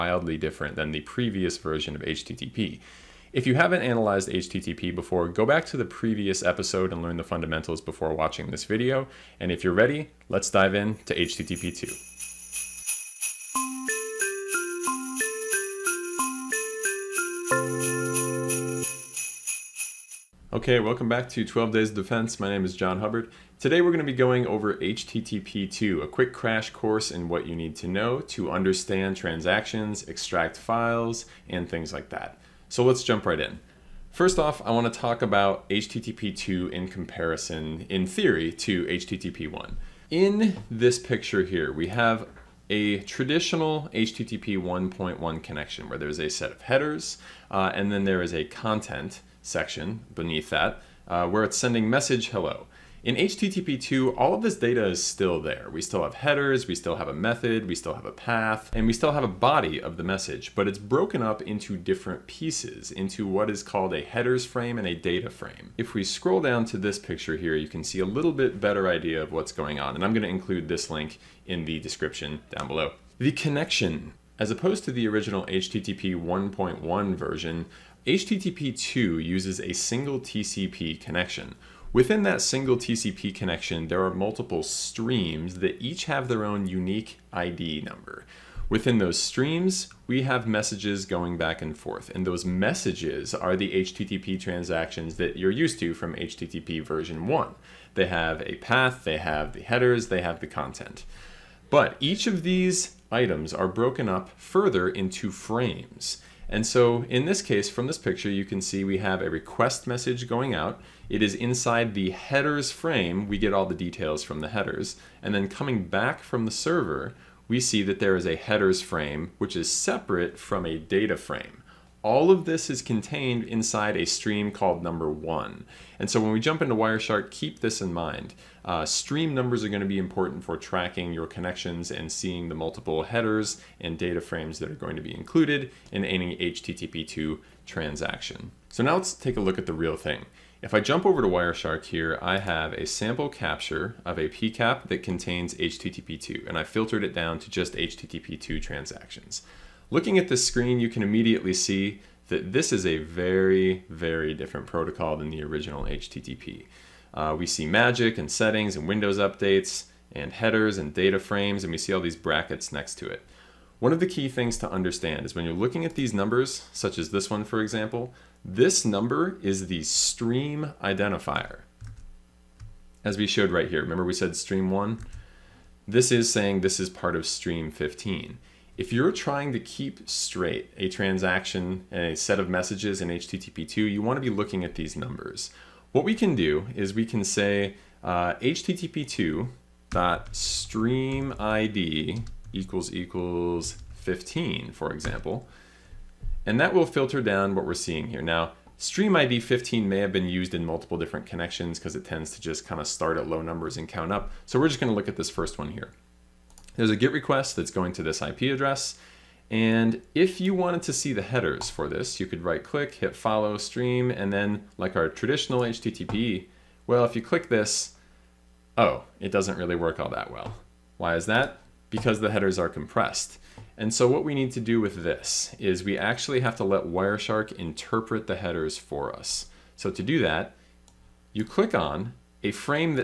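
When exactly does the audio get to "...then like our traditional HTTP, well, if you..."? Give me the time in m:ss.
3:34.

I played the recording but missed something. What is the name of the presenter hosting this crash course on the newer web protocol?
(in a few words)
John Hubbard.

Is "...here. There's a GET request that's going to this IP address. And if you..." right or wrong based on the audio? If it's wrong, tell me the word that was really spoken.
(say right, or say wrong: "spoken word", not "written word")
right.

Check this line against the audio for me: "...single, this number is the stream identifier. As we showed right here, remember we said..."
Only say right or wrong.
wrong.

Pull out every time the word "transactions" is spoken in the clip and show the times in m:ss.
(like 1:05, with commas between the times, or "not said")
0:29, 1:34, 2:17, 2:28, 3:00.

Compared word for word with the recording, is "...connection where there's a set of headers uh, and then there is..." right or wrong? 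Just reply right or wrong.
right.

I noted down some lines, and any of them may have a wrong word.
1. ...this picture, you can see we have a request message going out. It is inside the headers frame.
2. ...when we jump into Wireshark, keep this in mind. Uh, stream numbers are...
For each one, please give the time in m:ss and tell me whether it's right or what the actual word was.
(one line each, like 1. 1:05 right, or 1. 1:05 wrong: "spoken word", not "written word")
1. 1:47 right
2. 2:06 right.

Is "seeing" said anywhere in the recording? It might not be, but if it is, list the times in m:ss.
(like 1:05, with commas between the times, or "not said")
2:12, 3:17.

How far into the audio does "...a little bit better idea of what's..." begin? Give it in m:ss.
1:07.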